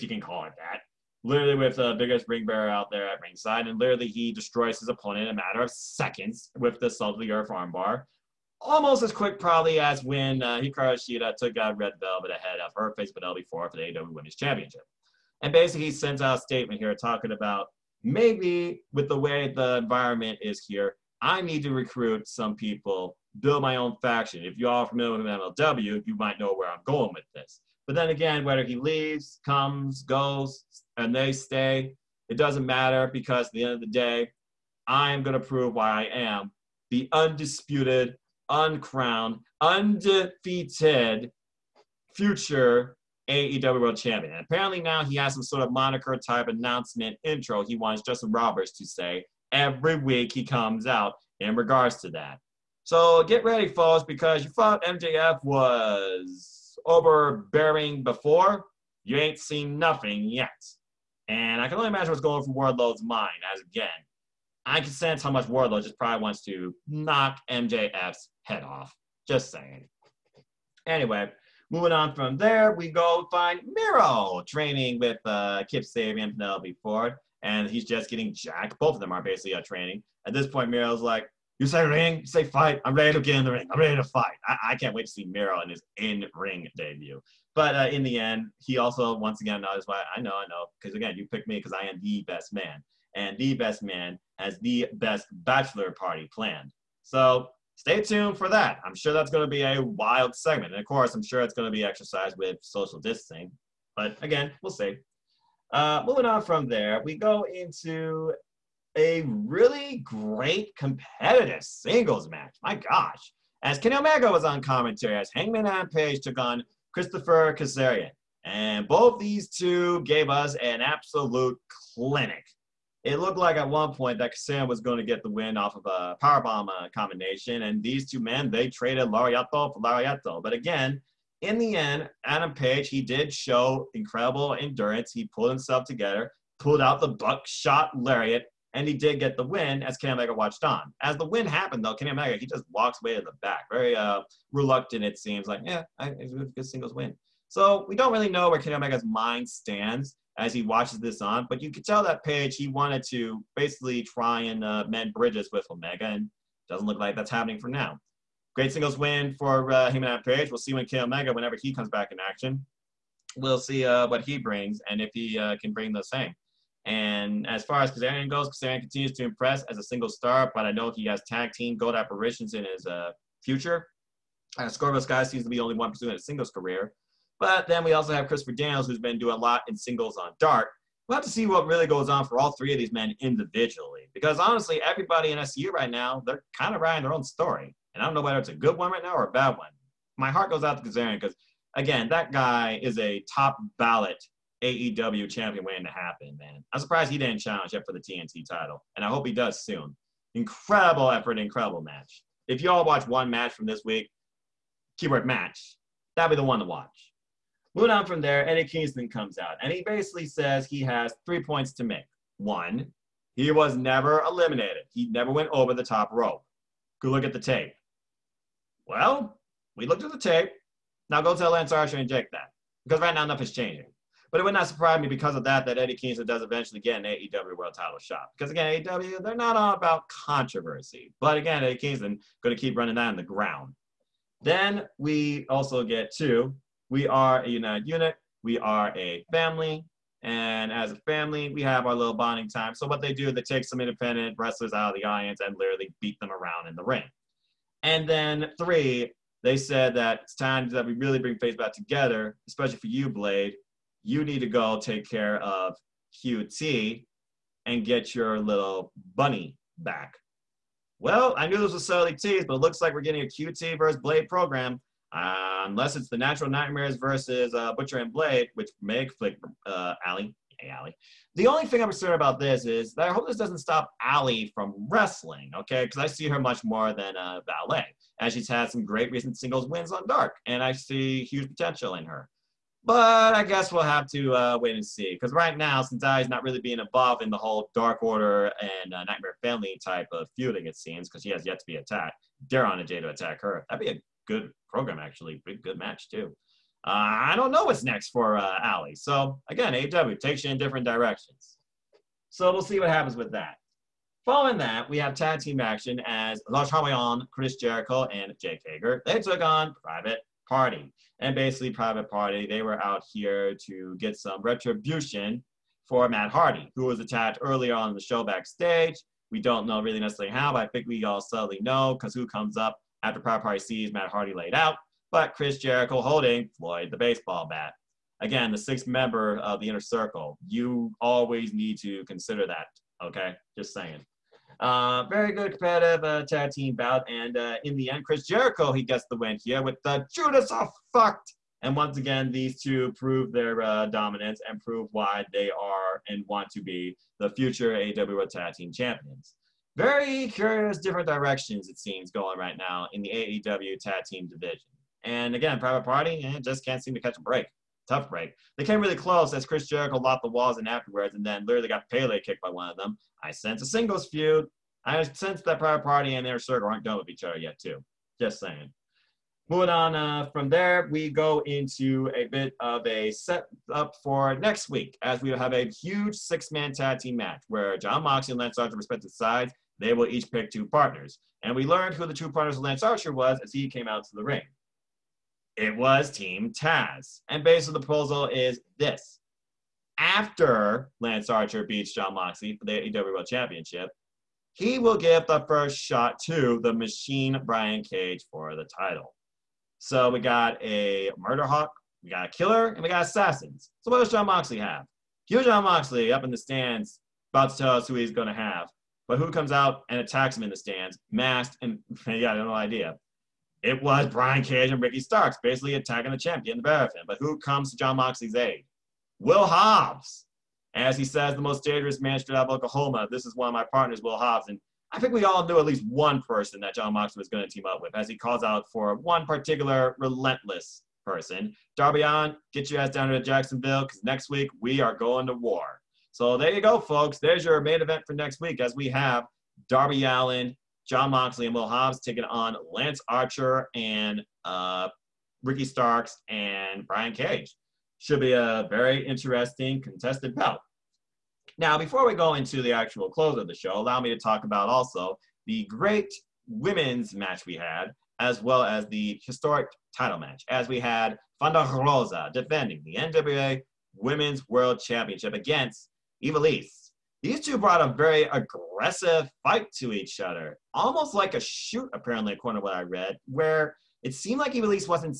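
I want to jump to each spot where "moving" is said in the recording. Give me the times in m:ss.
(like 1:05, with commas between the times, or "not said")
1:11, 1:46, 3:27, 6:09.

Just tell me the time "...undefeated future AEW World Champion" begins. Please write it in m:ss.
0:39.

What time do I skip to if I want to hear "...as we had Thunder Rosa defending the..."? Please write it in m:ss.
7:40.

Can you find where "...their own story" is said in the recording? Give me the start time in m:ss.
3:07.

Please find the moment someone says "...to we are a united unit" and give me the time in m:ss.
3:56.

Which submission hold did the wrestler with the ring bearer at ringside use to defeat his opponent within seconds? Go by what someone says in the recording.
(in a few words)
Salt of the earth armbar.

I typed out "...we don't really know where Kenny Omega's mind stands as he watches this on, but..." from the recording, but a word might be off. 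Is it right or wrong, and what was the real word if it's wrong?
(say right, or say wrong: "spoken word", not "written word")
right.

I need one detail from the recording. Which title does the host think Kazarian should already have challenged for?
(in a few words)
TNT title.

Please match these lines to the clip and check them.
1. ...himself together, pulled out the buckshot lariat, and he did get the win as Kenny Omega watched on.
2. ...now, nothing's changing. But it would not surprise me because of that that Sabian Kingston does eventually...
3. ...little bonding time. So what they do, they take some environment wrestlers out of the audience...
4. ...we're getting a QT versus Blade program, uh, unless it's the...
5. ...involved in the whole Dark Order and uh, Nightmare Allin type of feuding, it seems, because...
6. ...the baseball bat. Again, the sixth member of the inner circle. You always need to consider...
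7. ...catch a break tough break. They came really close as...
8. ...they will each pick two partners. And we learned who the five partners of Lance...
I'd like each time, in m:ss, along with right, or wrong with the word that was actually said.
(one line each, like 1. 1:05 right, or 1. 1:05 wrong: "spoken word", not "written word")
1. 2:15 right
2. 3:43 wrong: "Eddie", not "Sabian"
3. 4:01 wrong: "independent", not "environment"
4. 4:22 right
5. 4:46 wrong: "Family", not "Allin"
6. 5:26 right
7. 5:56 right
8. 6:19 wrong: "two", not "five".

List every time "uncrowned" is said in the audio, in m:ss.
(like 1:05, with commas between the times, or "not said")
0:38.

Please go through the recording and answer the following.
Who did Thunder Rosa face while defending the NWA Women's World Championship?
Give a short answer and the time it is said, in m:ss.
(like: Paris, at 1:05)
Ivelisse, at 7:46.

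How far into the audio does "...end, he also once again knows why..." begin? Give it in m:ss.
1:28.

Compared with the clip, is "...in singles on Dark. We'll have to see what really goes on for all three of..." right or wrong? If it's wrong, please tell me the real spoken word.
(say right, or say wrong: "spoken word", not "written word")
right.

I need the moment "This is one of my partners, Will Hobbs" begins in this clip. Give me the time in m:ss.
7:03.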